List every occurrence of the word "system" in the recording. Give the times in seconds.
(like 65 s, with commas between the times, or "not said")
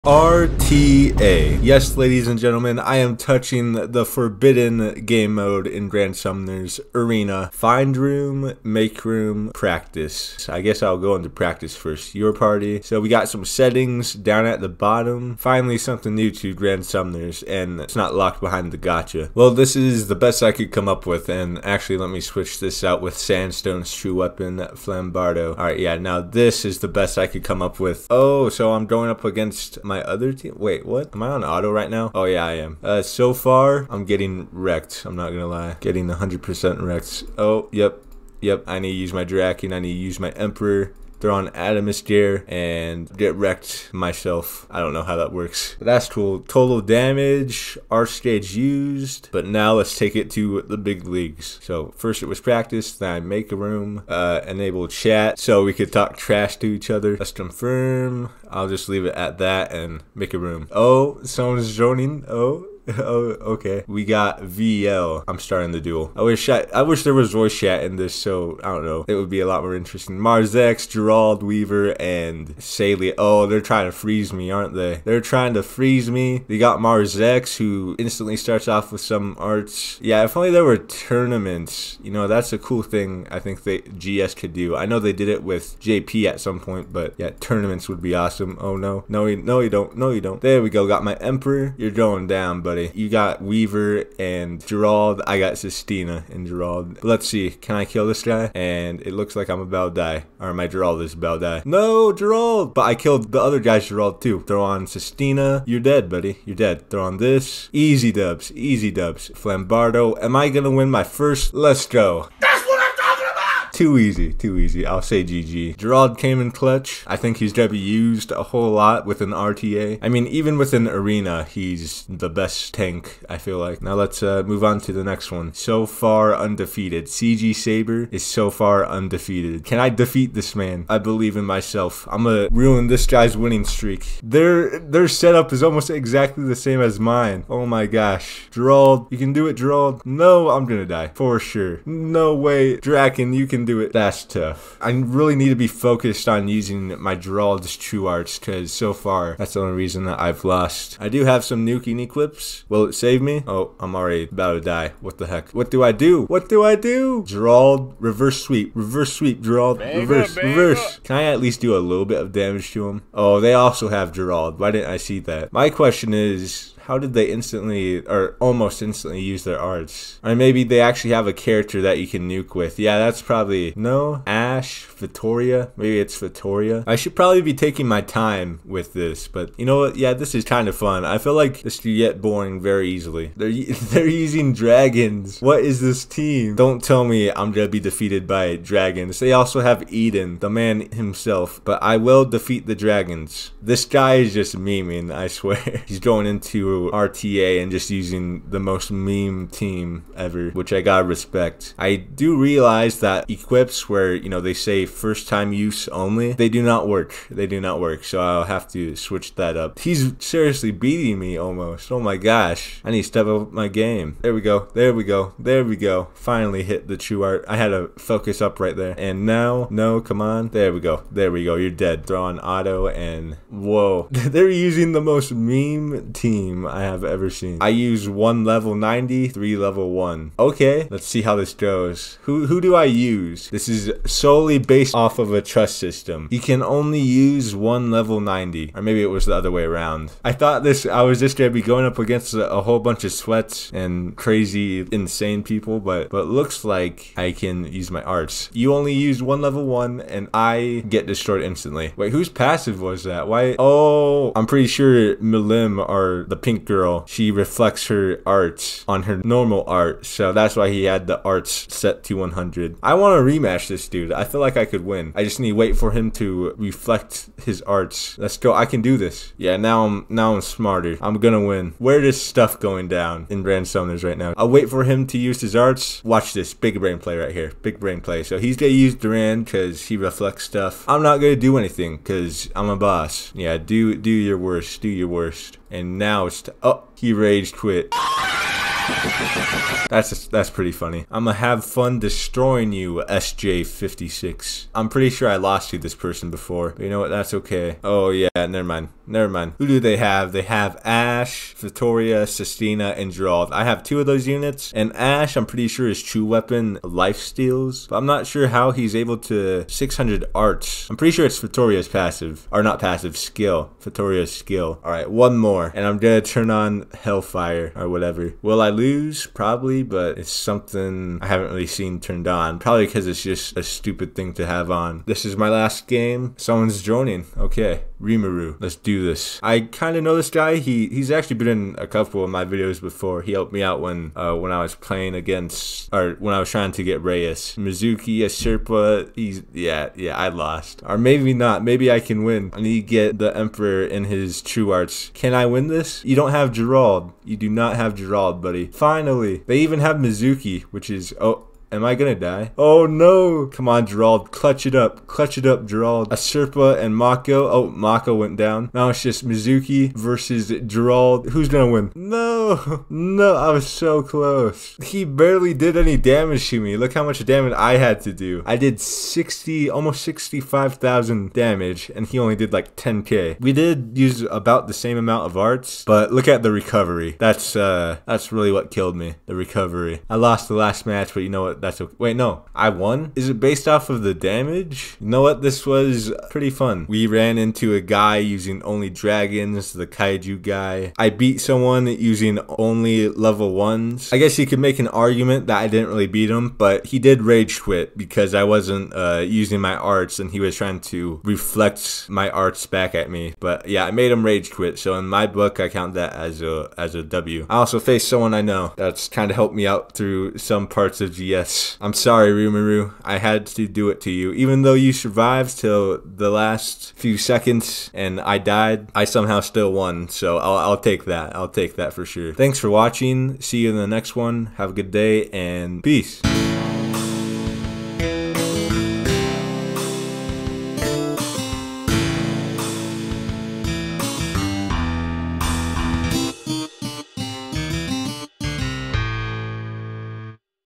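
235 s.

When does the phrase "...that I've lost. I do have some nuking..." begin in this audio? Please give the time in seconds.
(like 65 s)
150 s.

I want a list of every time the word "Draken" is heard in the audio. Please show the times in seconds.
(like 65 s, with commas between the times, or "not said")
39 s, 142 s.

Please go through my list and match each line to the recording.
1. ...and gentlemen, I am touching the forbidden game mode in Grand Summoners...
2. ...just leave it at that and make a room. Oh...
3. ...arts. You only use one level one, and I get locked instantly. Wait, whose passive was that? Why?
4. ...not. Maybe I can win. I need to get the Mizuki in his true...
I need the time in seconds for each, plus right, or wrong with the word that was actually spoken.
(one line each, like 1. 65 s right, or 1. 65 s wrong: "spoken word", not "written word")
1. 2 s right
2. 58 s right
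3. 248 s wrong: "destroyed", not "locked"
4. 341 s wrong: "Emperor", not "Mizuki".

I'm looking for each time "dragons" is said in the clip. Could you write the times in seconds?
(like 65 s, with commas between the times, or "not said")
184 s, 188 s, 192 s, 388 s.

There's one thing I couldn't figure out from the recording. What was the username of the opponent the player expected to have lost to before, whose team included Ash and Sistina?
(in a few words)
SJ56.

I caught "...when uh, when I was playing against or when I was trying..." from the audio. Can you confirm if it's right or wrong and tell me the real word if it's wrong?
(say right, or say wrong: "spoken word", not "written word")
right.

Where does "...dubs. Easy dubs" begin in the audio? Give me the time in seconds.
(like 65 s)
108 s.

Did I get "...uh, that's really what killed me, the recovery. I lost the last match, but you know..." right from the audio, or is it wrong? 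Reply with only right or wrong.
right.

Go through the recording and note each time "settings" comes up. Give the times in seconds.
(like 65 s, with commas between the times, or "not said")
13 s.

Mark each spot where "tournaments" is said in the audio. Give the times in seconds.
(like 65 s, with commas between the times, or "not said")
80 s, 87 s.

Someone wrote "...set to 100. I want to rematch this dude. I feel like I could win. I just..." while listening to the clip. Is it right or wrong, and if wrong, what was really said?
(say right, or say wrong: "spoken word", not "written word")
right.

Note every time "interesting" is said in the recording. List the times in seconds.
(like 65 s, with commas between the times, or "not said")
69 s.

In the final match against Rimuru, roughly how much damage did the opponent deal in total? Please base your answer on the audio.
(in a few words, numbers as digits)
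10k.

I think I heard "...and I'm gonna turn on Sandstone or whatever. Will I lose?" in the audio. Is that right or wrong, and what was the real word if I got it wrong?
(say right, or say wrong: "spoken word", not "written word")
wrong: "Hellfire", not "Sandstone".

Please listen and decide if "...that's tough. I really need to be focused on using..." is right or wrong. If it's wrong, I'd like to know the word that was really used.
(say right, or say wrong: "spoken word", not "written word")
right.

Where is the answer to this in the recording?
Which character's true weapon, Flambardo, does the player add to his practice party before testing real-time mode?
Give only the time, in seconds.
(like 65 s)
23 s.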